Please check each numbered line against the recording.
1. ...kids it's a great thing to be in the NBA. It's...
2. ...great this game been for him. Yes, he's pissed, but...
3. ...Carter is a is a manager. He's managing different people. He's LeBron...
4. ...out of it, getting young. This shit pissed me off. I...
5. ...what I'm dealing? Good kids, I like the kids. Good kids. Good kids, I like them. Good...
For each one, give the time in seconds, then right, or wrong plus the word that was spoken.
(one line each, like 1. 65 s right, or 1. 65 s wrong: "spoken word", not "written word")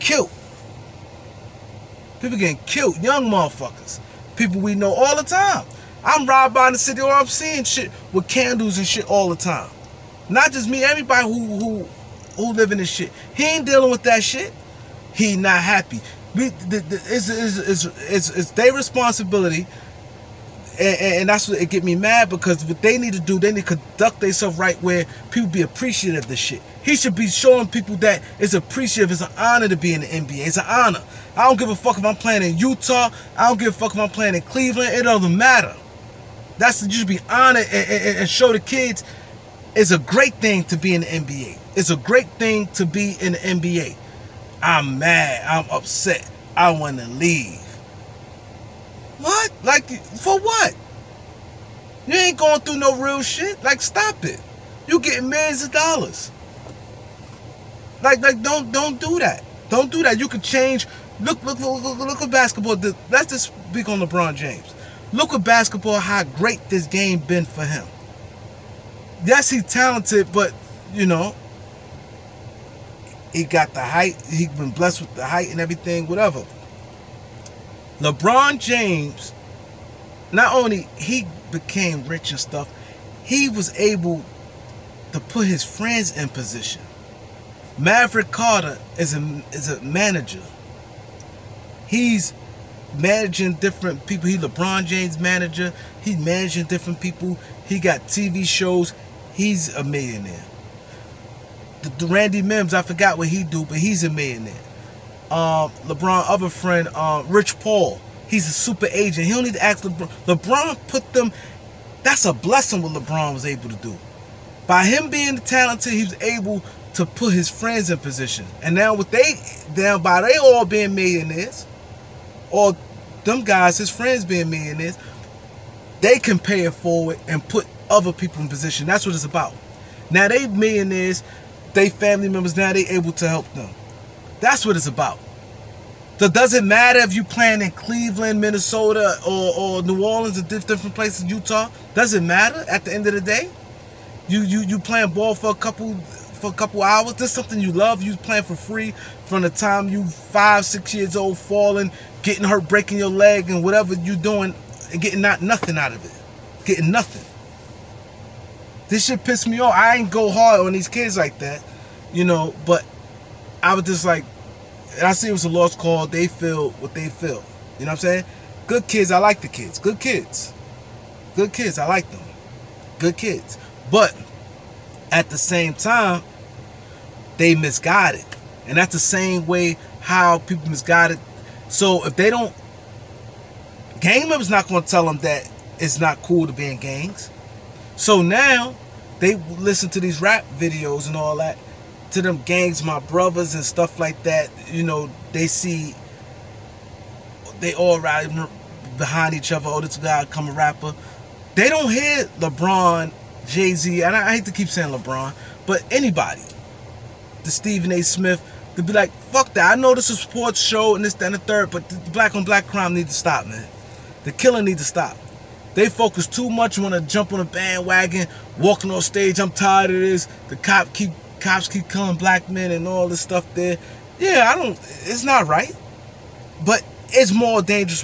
1. 38 s right
2. 66 s wrong: "talented", not "pissed"
3. 88 s right
4. 155 s wrong: "nothing", not "young"
5. 167 s wrong: "saying", not "dealing".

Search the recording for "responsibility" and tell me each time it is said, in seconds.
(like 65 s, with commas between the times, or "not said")
18 s.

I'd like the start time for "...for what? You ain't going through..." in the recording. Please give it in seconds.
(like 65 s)
50 s.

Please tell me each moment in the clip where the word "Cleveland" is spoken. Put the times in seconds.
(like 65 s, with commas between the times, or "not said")
34 s, 137 s.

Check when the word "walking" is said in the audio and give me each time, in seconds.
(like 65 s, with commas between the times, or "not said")
218 s.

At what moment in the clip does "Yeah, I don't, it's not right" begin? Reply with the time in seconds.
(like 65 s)
224 s.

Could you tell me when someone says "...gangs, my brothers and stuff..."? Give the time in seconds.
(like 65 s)
192 s.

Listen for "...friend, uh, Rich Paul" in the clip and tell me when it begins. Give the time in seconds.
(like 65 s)
106 s.